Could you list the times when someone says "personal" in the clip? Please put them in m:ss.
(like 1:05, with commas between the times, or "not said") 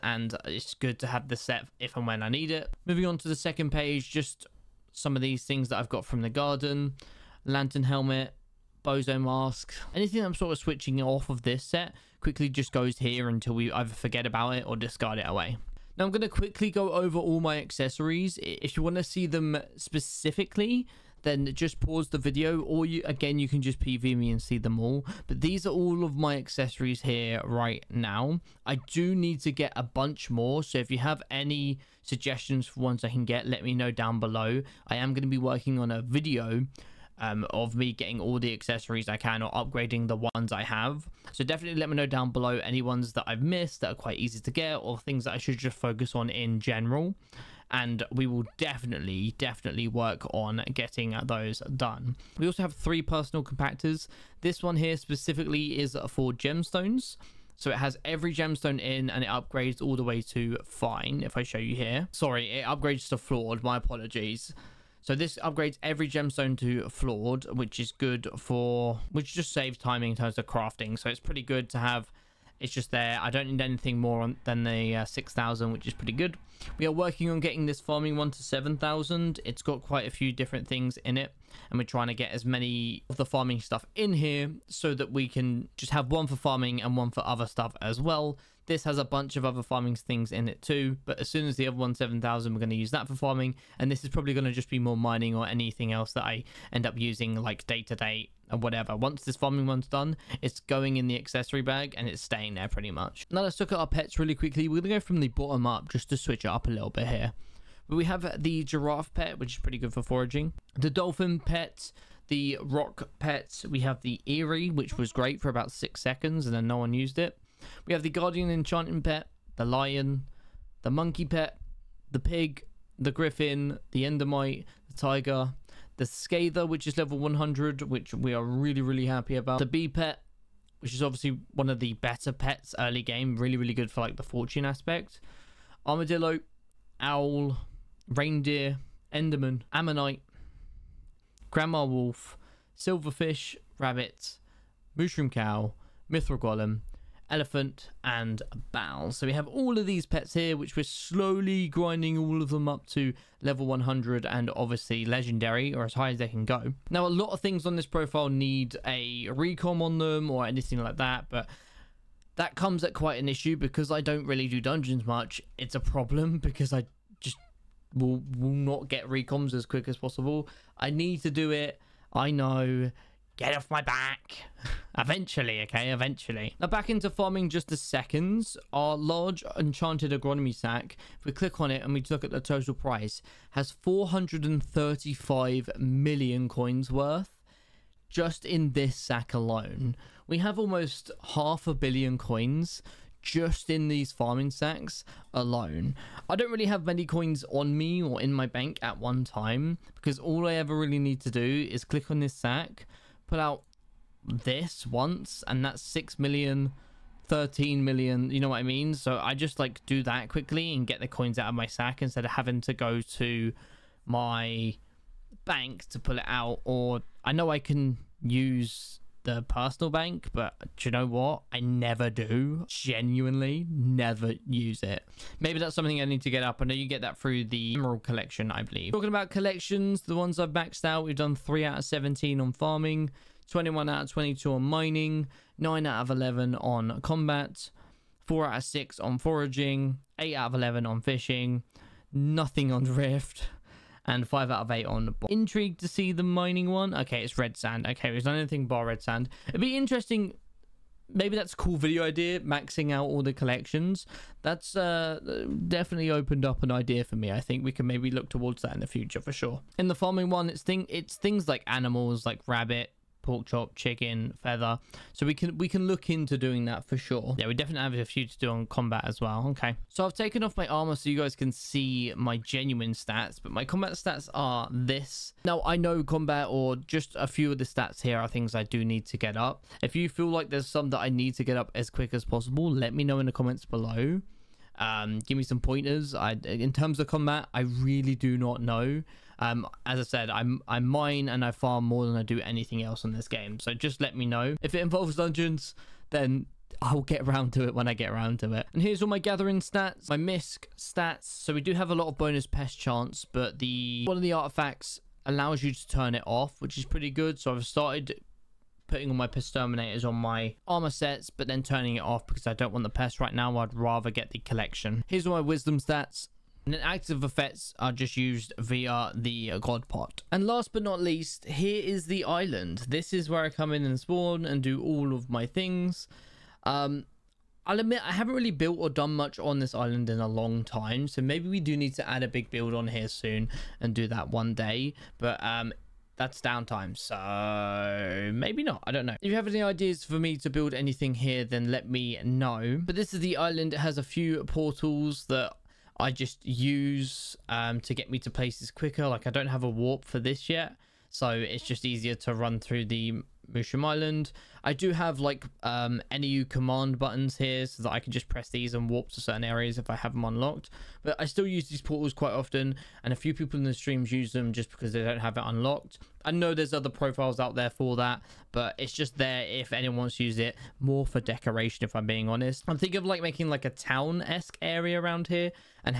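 0:53, 3:39.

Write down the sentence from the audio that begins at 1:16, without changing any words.
We are working on getting this farming one to 7,000.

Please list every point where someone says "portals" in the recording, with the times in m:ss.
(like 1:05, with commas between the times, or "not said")
5:44, 6:01.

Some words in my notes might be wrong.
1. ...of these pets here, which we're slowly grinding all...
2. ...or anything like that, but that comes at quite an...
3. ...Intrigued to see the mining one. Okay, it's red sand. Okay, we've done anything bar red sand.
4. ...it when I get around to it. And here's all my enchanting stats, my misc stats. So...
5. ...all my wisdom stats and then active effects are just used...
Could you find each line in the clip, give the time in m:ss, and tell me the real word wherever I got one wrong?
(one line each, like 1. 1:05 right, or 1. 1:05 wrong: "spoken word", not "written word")
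1. 2:29 right
2. 2:40 right
3. 4:05 right
4. 4:57 wrong: "gathering", not "enchanting"
5. 5:15 right.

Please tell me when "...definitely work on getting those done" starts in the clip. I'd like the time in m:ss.
0:49.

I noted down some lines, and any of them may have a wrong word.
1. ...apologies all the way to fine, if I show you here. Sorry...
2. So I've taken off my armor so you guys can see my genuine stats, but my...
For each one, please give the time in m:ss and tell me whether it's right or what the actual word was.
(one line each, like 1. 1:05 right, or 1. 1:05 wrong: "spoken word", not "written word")
1. 0:59 wrong: "upgrades", not "apologies"
2. 4:29 right.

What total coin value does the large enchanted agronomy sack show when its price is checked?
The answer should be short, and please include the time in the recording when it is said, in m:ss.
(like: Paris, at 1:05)
435 million coins, at 3:03.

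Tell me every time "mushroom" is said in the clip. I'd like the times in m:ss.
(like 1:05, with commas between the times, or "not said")
2:24, 5:53.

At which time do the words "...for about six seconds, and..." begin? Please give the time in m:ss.
1:55.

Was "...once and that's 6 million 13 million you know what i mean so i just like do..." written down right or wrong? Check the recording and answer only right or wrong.
right.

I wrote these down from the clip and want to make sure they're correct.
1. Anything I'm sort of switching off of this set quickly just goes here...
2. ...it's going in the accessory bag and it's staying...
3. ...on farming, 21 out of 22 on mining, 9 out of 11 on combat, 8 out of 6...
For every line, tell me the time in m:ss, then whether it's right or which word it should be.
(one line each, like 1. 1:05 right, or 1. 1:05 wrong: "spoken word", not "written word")
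1. 0:09 right
2. 1:40 right
3. 3:52 wrong: "4", not "8".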